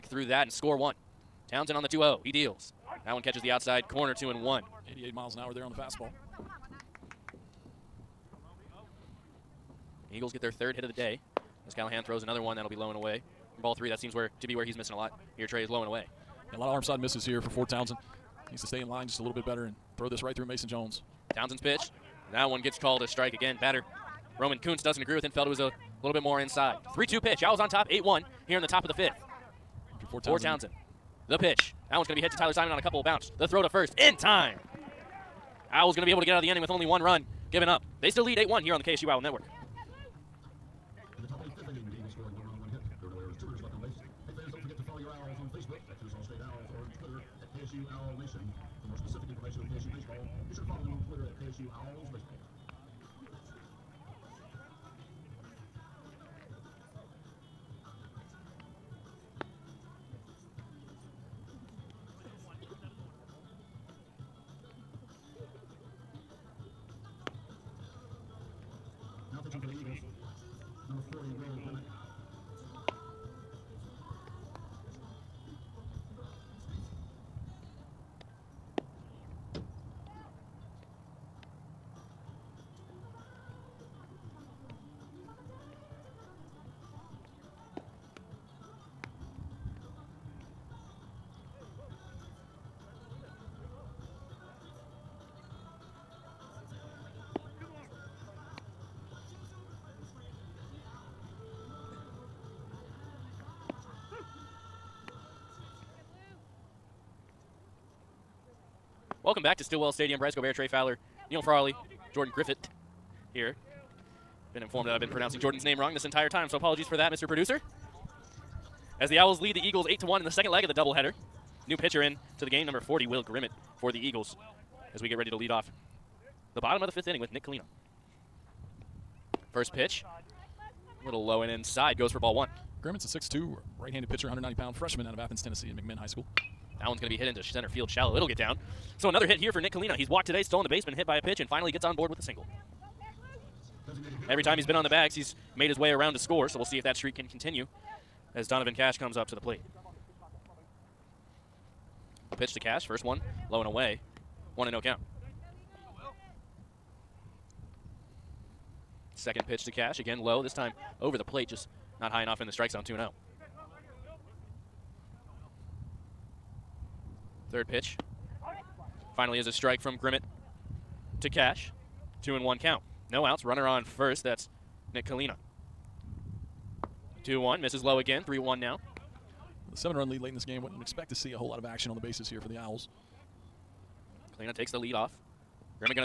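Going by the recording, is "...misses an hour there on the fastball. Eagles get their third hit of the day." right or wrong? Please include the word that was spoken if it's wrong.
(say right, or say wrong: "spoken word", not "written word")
wrong: "miles", not "misses".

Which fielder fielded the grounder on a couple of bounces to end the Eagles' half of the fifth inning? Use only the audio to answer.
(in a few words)
Tyler Simon.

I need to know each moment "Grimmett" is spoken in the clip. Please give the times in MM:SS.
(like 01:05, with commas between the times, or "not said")
02:03, 02:12, 02:49.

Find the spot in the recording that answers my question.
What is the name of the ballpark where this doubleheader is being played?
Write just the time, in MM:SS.
01:49.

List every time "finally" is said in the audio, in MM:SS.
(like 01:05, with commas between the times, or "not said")
02:21, 02:49.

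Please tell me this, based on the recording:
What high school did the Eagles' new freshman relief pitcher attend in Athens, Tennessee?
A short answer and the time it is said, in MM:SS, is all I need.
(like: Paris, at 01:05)
McMinn High School, at 02:15.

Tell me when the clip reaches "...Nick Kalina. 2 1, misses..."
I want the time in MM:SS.
02:54.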